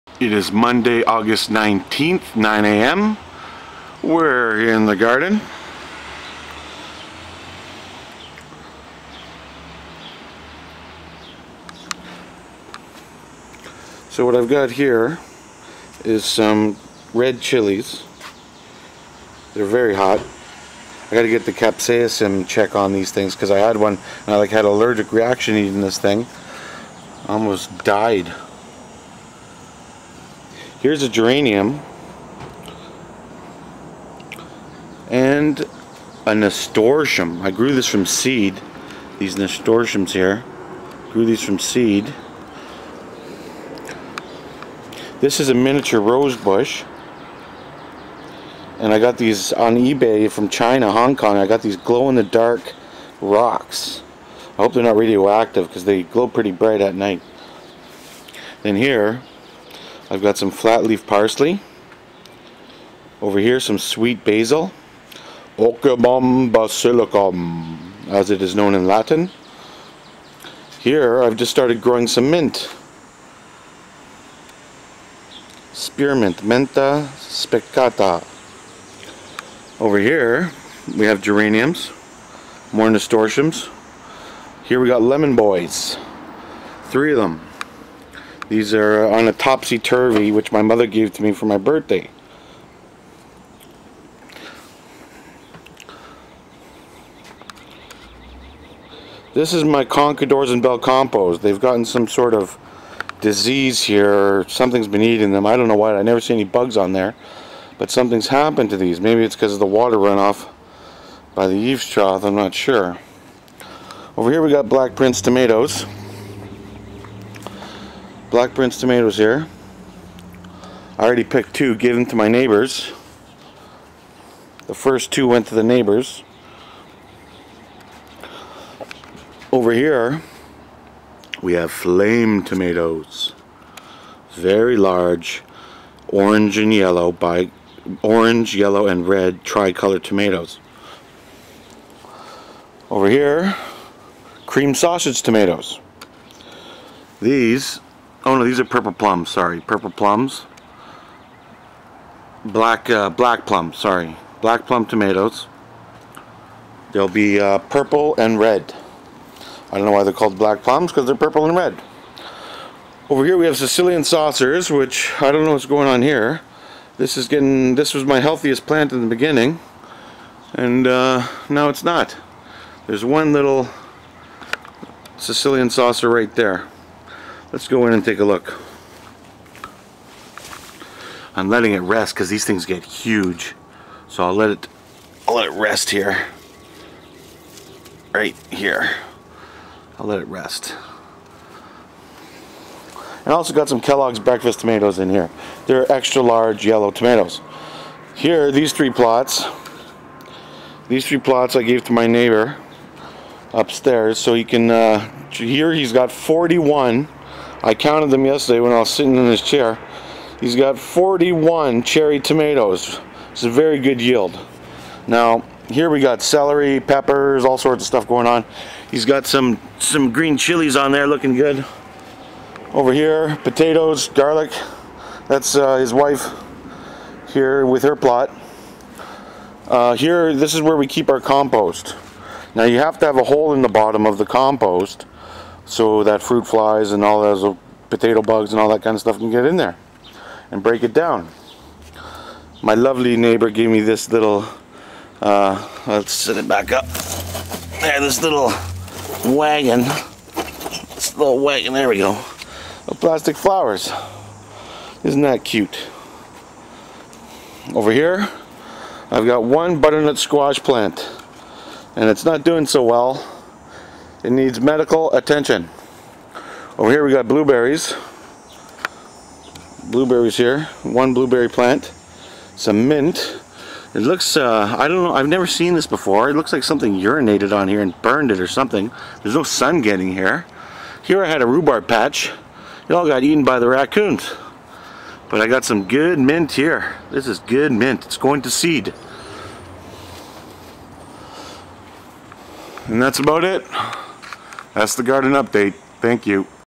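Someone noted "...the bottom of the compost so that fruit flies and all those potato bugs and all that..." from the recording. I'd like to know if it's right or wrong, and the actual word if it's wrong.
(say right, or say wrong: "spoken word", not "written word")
right.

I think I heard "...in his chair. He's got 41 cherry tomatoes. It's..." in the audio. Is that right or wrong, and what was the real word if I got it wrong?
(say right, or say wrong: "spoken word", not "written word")
right.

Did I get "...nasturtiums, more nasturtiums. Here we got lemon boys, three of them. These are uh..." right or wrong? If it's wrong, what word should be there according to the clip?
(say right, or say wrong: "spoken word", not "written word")
wrong: "geraniums", not "nasturtiums".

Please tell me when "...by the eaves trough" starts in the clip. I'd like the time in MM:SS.
01:51.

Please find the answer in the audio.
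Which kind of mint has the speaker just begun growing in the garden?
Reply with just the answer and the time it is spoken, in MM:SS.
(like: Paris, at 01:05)
Spearmint, at 01:15.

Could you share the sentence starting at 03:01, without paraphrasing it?
I'm letting it rest because these things get huge.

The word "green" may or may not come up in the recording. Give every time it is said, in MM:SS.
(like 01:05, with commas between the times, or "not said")
03:40.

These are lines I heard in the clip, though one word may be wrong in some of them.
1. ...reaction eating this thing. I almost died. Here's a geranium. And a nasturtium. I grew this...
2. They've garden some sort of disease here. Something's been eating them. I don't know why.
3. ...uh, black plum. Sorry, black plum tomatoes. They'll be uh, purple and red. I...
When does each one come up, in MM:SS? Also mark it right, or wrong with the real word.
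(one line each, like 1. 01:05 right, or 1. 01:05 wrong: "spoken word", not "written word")
1. 00:25 right
2. 01:41 wrong: "gotten", not "garden"
3. 02:32 right.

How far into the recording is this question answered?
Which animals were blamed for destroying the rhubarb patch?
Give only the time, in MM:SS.
04:43.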